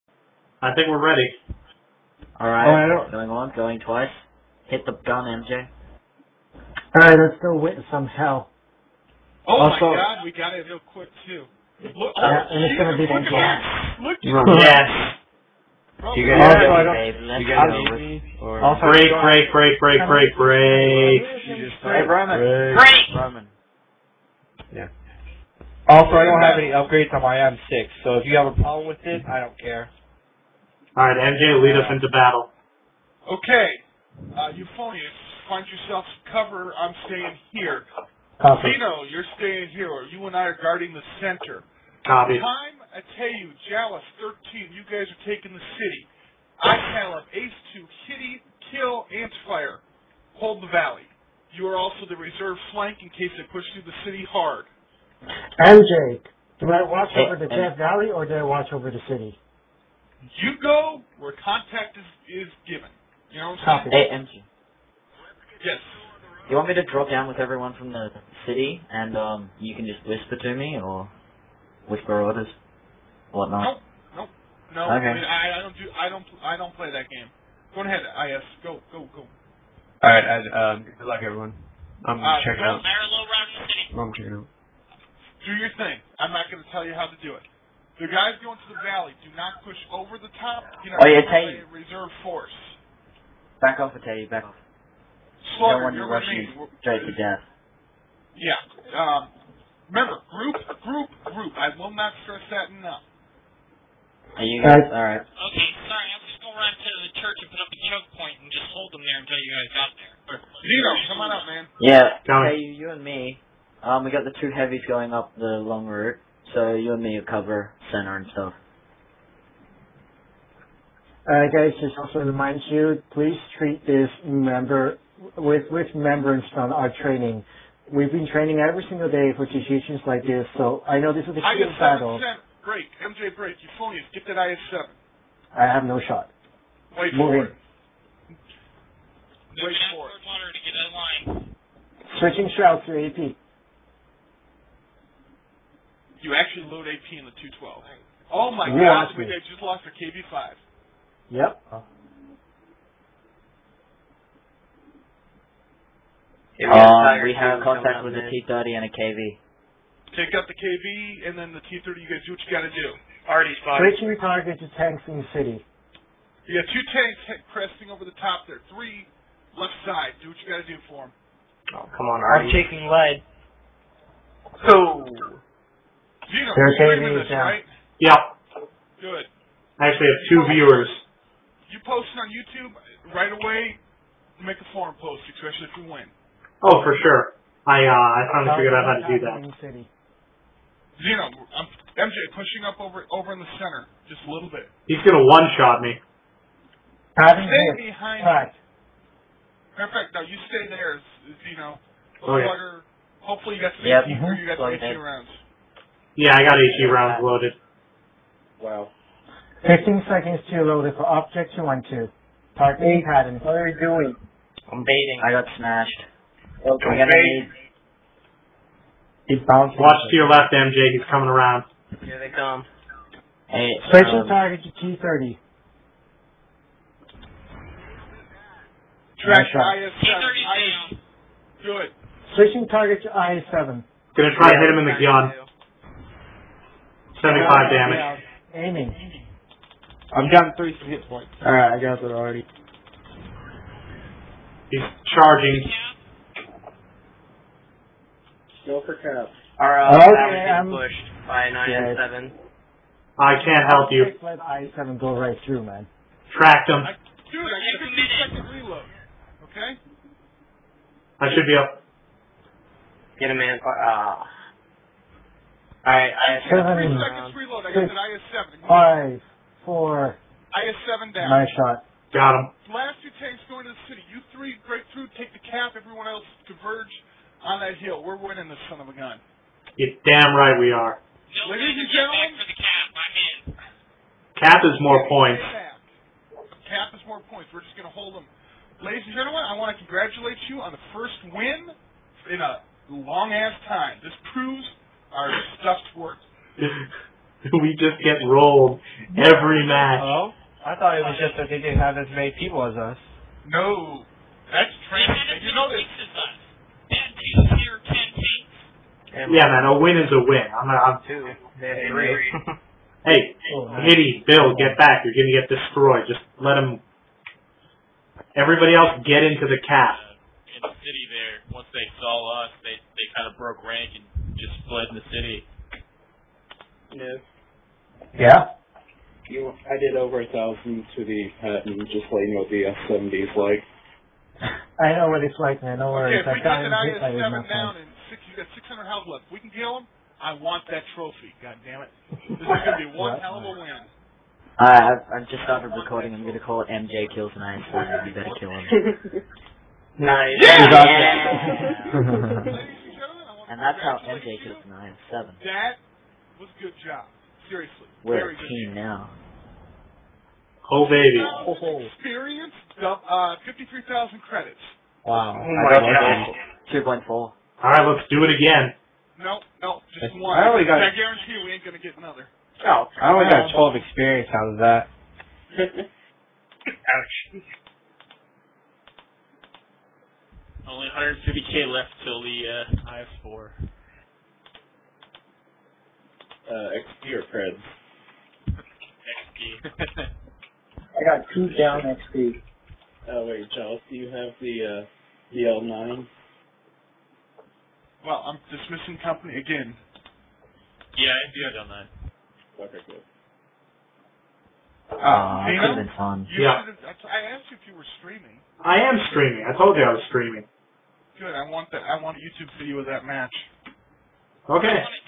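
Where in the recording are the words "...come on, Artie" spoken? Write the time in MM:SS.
02:51.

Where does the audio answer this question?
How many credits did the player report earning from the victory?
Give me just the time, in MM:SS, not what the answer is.
06:03.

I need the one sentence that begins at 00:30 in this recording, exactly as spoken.
All right, MJ, lead us into battle.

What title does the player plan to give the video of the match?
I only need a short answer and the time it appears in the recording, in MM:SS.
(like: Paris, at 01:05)
MJ kills nine, at 05:46.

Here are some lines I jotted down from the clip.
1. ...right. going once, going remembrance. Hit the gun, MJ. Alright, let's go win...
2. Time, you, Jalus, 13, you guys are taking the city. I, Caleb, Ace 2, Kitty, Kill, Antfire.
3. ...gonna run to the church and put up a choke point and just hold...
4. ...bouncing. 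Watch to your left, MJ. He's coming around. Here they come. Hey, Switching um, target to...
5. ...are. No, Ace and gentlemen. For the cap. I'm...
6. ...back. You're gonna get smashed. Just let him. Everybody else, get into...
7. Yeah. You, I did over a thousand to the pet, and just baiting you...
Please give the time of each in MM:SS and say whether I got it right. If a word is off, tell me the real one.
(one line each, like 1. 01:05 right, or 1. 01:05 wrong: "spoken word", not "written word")
1. 00:02 wrong: "twice", not "remembrance"
2. 00:42 right
3. 01:46 right
4. 03:39 right
5. 04:40 wrong: "Ladies", not "Ace"
6. 05:14 wrong: "destroyed", not "smashed"
7. 05:28 wrong: "letting", not "baiting".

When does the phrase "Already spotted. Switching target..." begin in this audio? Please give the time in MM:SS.
02:43.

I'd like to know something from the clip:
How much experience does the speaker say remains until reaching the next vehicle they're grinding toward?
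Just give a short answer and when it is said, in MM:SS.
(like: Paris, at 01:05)
150k, at 06:21.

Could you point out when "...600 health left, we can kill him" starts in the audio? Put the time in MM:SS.
05:38.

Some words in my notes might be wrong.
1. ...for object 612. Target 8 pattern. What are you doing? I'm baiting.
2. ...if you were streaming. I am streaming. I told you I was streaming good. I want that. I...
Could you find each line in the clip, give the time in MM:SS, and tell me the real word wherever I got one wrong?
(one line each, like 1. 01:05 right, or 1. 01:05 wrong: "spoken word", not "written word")
1. 03:30 wrong: "212", not "612"
2. 06:47 right.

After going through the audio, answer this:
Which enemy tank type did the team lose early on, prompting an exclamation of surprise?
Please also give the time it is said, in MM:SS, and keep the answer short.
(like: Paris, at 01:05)
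KV-5, at 02:29.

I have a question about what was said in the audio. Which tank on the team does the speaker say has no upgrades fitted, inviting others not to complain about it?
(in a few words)
M6.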